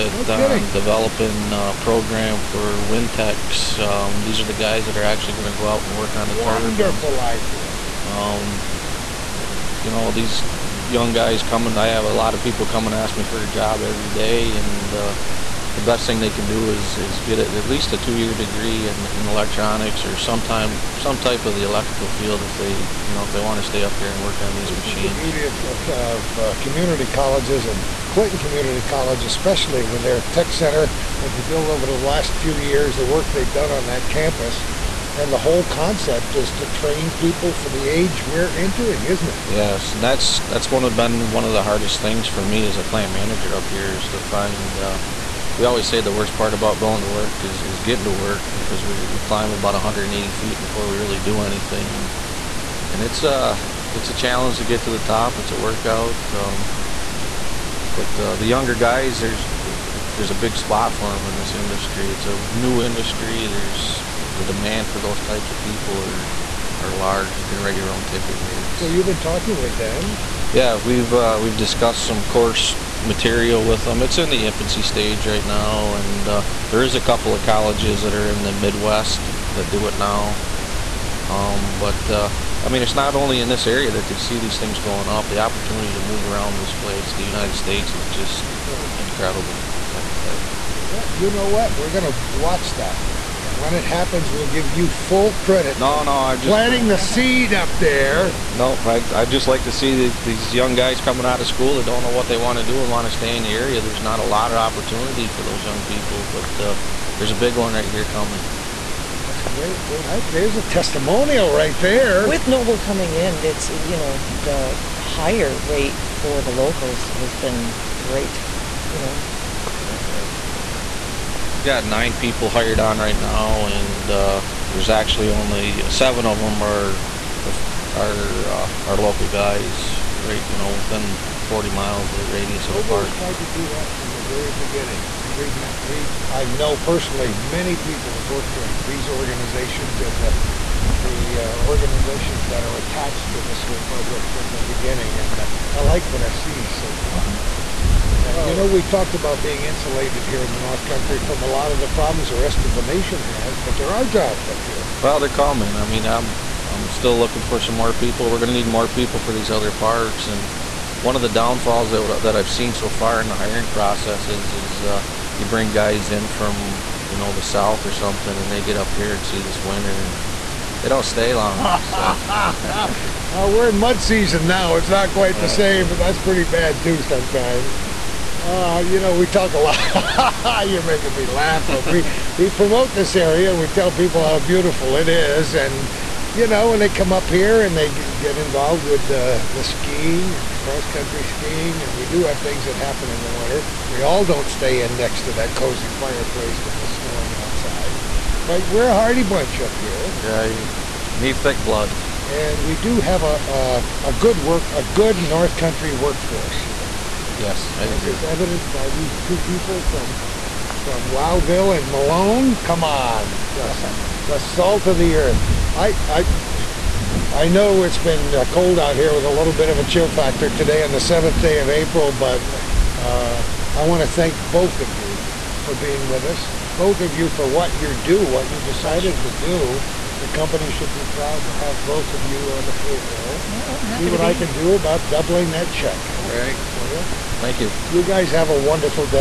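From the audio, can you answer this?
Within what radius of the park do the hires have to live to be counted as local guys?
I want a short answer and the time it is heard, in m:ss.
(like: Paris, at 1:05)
40 miles, at 2:11.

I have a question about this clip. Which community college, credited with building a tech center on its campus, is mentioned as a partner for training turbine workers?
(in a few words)
Clinton Community College.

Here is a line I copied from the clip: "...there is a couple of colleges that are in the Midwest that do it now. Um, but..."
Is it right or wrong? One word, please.
right.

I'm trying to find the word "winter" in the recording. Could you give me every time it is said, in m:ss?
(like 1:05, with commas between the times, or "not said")
2:49, 3:13.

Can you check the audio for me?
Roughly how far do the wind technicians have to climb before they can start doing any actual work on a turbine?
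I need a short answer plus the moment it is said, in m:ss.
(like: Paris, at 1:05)
180 feet, at 0:49.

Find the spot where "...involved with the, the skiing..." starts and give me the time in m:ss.
3:08.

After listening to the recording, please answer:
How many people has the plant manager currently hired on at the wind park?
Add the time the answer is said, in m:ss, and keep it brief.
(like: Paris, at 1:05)
9, at 2:01.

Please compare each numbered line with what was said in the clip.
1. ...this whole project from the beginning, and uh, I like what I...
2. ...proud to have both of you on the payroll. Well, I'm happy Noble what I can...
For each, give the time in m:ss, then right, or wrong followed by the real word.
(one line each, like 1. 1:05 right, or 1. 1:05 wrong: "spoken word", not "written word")
1. 2:23 right
2. 3:51 wrong: "See", not "Noble".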